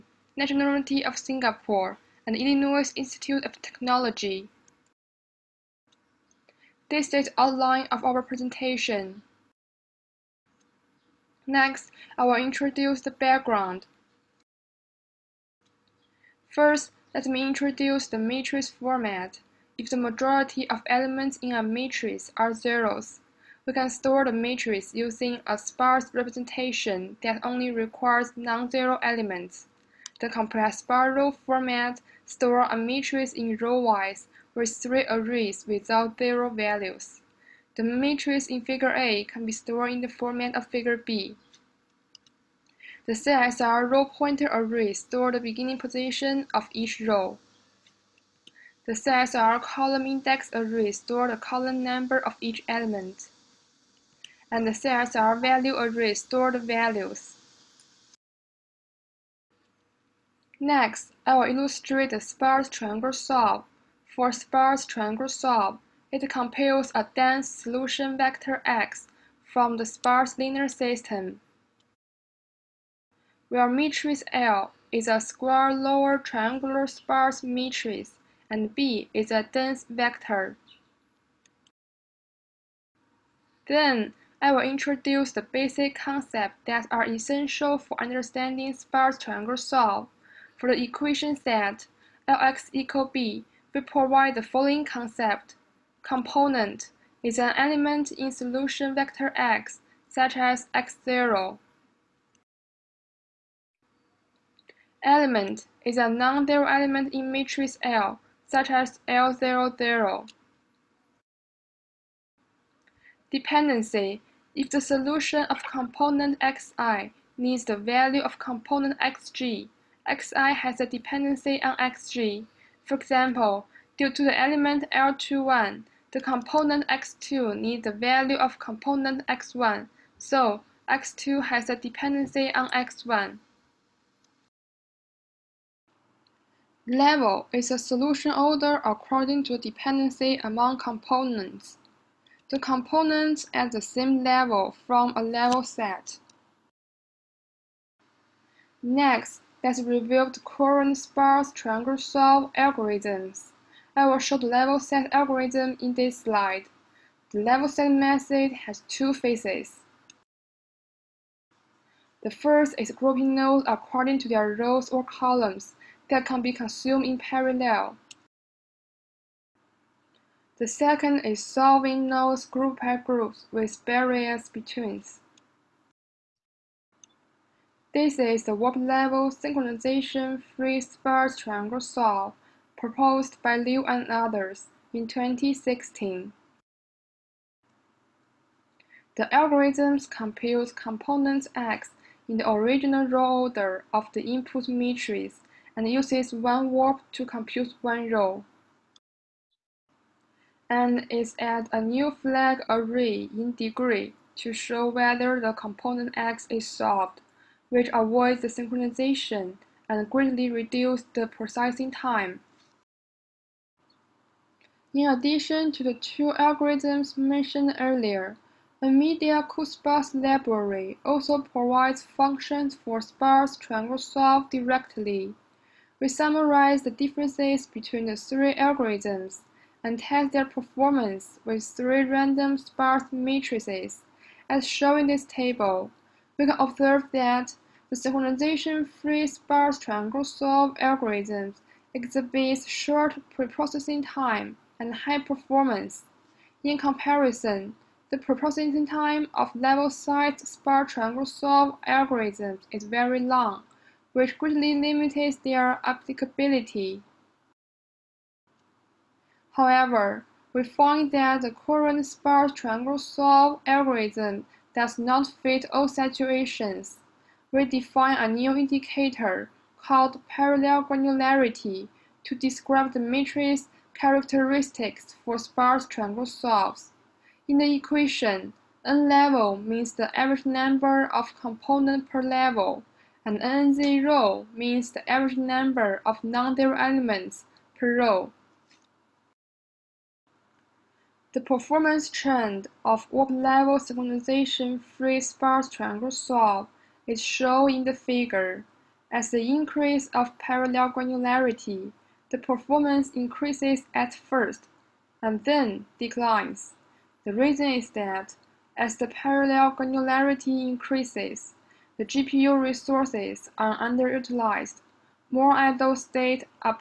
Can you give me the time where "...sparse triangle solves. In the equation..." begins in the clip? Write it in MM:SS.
04:35.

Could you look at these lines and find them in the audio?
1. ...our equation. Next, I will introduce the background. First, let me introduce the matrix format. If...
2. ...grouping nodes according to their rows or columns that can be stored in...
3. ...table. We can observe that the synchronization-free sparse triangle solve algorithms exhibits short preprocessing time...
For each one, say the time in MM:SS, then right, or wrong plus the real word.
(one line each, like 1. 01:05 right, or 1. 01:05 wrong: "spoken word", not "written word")
1. 00:08 wrong: "presentation", not "equation"
2. 02:42 wrong: "consumed", not "stored"
3. 03:55 right.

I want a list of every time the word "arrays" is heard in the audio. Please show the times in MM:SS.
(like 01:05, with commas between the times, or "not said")
00:35, 00:44, 00:50, 00:55, 03:22.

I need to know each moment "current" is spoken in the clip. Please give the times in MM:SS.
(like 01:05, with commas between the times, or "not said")
02:30, 04:21.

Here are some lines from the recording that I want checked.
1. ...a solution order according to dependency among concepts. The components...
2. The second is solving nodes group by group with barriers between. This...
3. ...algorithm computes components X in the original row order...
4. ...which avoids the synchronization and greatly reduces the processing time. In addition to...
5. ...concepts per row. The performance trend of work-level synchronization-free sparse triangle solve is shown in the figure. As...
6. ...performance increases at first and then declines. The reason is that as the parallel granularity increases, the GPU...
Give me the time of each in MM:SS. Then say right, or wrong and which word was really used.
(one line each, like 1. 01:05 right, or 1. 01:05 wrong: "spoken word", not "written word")
1. 02:17 wrong: "components", not "concepts"
2. 02:50 right
3. 03:09 right
4. 03:27 right
5. 04:46 wrong: "elements", not "concepts"
6. 05:02 right.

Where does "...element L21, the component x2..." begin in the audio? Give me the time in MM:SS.
02:04.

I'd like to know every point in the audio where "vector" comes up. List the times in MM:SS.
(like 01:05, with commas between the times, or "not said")
01:08, 01:19, 01:38.